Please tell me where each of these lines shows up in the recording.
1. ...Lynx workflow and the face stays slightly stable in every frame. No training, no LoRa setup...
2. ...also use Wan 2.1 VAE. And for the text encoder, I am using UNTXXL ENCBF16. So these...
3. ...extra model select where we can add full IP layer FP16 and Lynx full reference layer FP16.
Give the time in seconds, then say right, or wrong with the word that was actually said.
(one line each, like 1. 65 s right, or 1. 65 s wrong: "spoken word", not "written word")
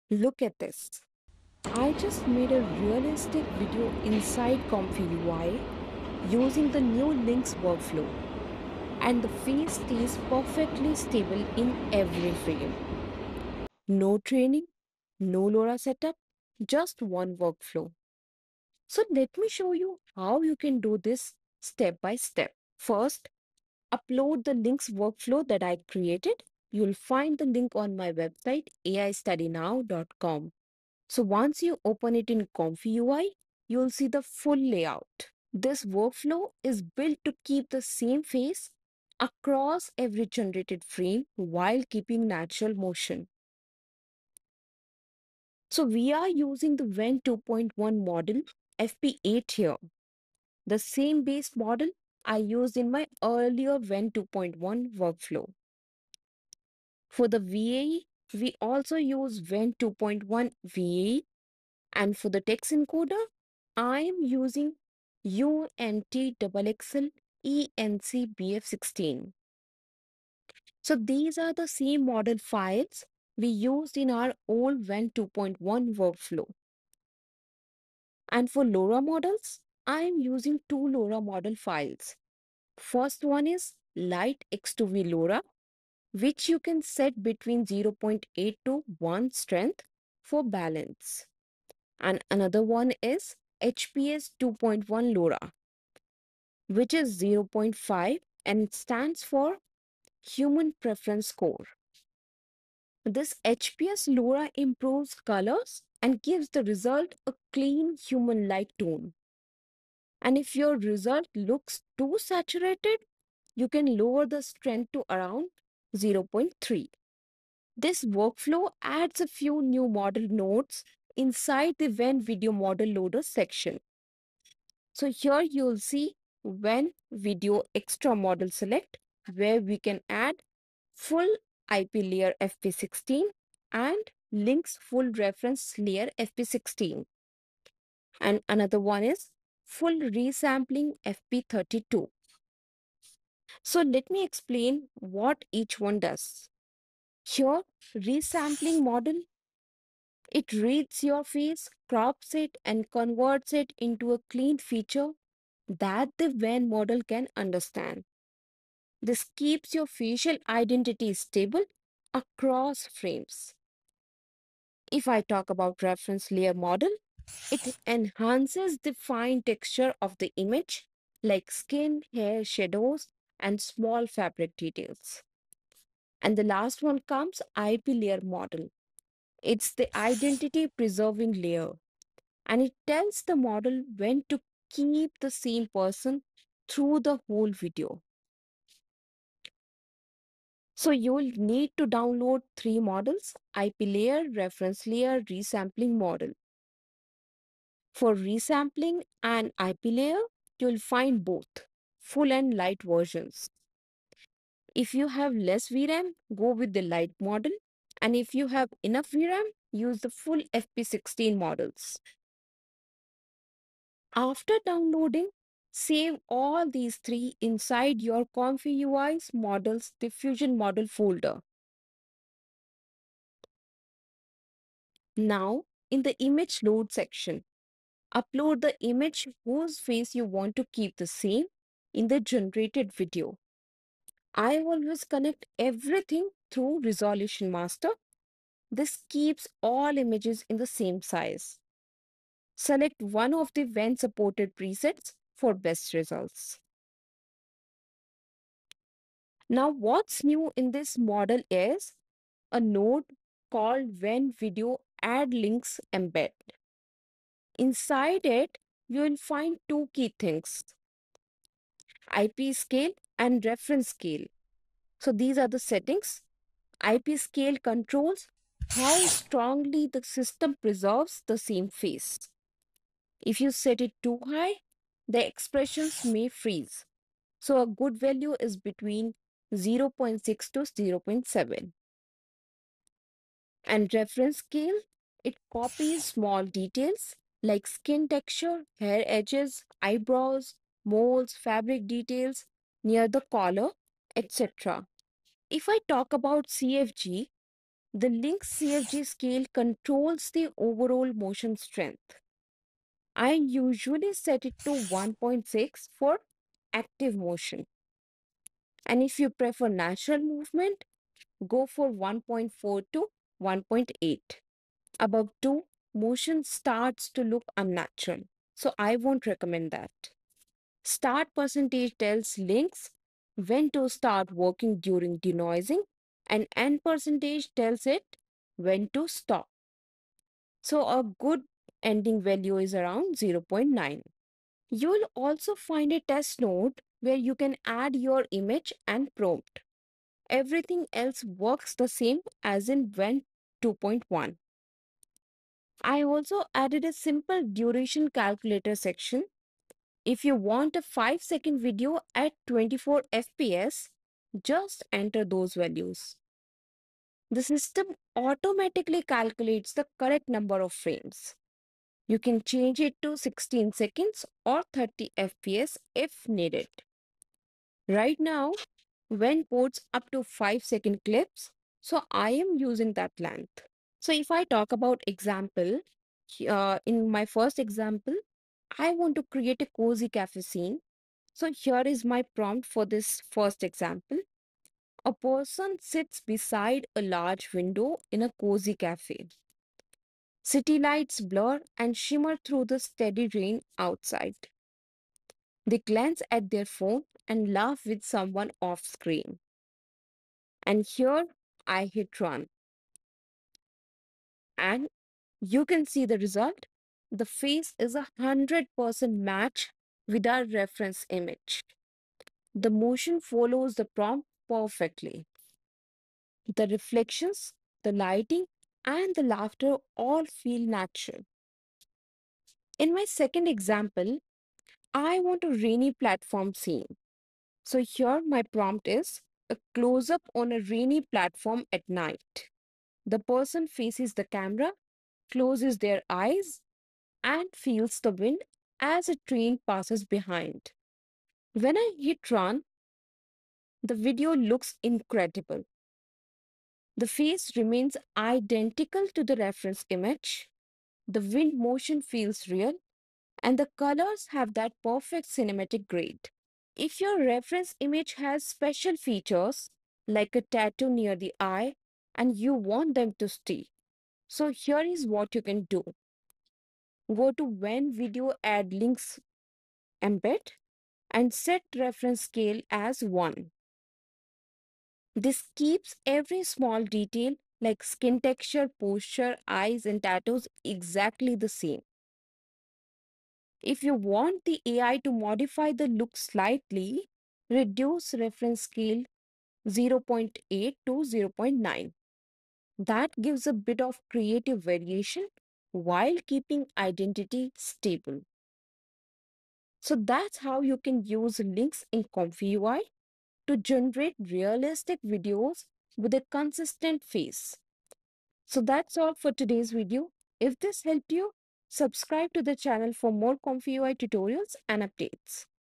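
1. 7 s wrong: "perfectly", not "slightly"
2. 58 s right
3. 127 s right.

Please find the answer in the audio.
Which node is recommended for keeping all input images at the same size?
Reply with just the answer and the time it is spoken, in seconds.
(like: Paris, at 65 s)
Resolution Master, at 236 s.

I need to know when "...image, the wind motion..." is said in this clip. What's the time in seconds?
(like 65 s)
449 s.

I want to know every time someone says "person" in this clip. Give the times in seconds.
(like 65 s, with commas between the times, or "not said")
185 s, 385 s, 433 s.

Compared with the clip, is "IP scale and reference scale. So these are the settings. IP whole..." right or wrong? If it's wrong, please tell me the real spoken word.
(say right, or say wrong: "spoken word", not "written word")
wrong: "scale", not "whole".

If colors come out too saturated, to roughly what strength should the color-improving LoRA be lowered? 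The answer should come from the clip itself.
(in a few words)
0.3.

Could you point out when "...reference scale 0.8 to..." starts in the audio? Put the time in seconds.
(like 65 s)
488 s.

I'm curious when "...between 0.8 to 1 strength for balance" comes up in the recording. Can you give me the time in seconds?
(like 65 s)
87 s.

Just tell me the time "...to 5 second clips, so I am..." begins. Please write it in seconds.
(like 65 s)
370 s.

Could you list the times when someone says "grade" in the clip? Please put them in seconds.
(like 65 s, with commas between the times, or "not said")
455 s.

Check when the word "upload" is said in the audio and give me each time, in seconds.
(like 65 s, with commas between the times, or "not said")
23 s, 228 s.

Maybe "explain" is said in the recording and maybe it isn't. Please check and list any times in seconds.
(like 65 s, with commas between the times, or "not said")
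144 s.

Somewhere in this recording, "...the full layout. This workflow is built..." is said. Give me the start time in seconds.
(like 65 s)
34 s.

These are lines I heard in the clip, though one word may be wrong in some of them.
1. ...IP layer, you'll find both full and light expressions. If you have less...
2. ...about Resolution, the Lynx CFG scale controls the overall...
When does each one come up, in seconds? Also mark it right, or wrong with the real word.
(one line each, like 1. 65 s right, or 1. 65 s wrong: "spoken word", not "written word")
1. 199 s wrong: "versions", not "expressions"
2. 296 s wrong: "CFG", not "Resolution".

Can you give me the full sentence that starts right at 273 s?
If you set it too high, the expressions may freeze.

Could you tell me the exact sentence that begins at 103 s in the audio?
This HPS LoRa improves colors and gives the result a clean human-like tone.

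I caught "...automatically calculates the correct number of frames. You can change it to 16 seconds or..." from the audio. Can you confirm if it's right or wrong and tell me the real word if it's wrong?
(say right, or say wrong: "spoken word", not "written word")
right.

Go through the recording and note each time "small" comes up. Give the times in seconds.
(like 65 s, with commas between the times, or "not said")
173 s, 286 s, 476 s.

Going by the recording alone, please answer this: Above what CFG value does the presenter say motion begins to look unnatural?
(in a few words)
2.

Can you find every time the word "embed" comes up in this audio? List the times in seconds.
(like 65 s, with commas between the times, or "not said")
255 s, 470 s.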